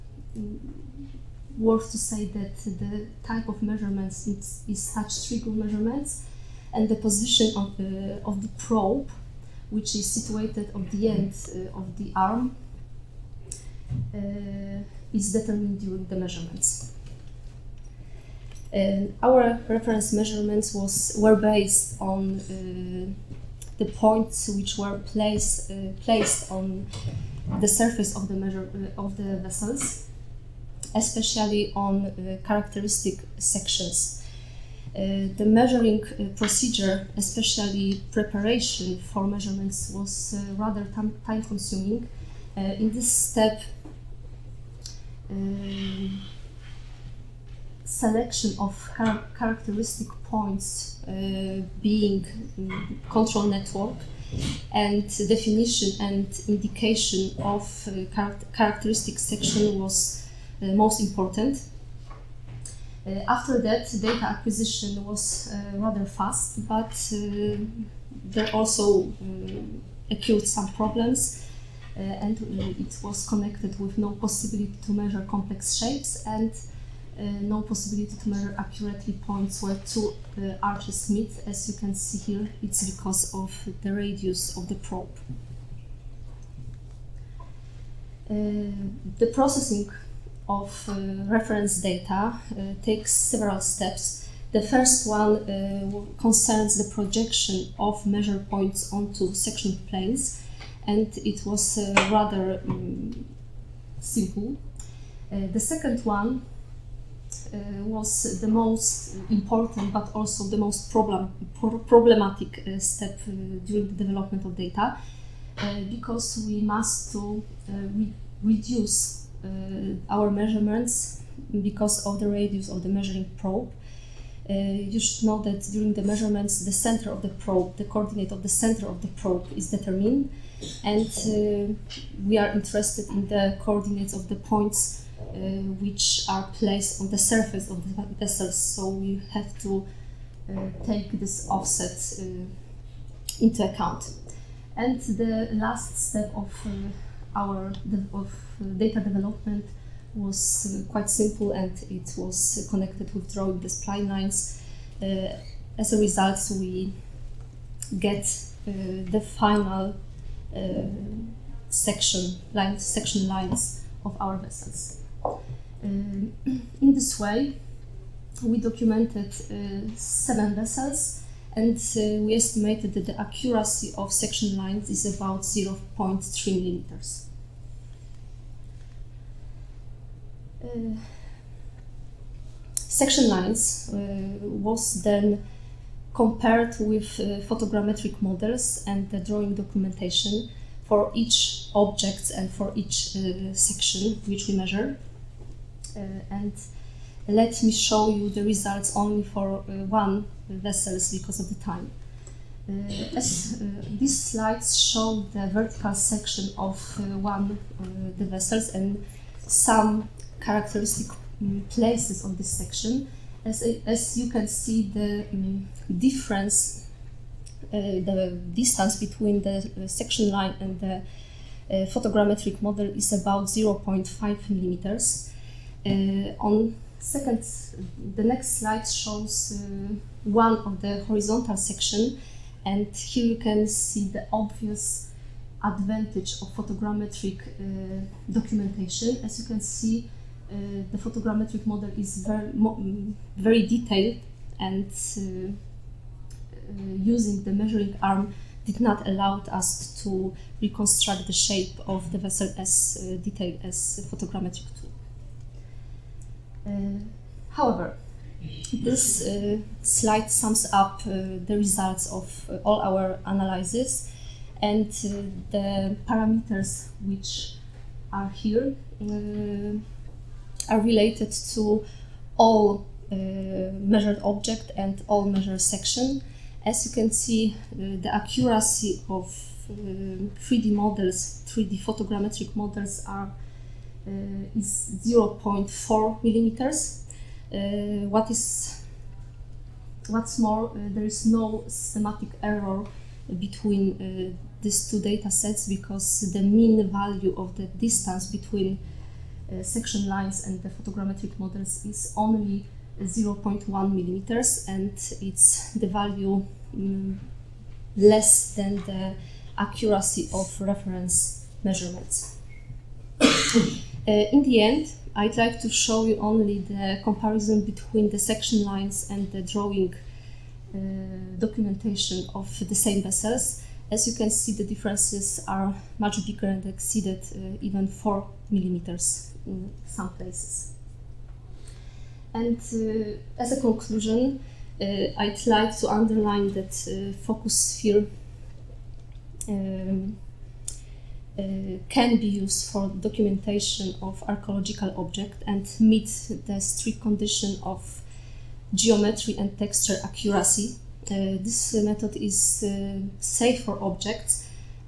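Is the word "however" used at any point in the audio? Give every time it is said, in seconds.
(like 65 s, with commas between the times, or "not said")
257 s.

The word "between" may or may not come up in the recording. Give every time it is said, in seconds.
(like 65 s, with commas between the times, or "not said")
218 s, 293 s, 298 s, 317 s.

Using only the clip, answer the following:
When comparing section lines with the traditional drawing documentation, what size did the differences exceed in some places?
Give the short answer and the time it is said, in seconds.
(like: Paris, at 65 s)
4 millimeters, at 327 s.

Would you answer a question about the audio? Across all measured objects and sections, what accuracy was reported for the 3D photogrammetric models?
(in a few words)
0.4 millimeters.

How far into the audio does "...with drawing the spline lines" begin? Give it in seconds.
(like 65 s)
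153 s.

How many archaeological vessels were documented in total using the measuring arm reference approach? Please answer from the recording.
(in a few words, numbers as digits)
7.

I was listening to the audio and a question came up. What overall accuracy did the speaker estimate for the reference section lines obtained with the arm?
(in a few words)
0.3 millimeters.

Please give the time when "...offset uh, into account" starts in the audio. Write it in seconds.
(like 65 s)
141 s.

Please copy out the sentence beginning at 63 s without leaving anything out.
Uh, after that, data acquisition was uh, rather fast, but there also occurred some problems.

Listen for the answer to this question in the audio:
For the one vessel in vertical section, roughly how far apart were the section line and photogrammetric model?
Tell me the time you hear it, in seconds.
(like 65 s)
223 s.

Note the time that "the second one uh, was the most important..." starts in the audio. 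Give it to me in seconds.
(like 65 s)
105 s.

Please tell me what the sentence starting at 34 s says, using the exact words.
Uh, the measuring uh, procedure, especially preparation for measurements, was uh, rather time consuming.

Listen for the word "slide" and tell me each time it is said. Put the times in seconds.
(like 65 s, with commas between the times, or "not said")
204 s, 228 s, 259 s.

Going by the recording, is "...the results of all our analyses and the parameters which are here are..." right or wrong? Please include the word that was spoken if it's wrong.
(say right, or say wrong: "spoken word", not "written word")
right.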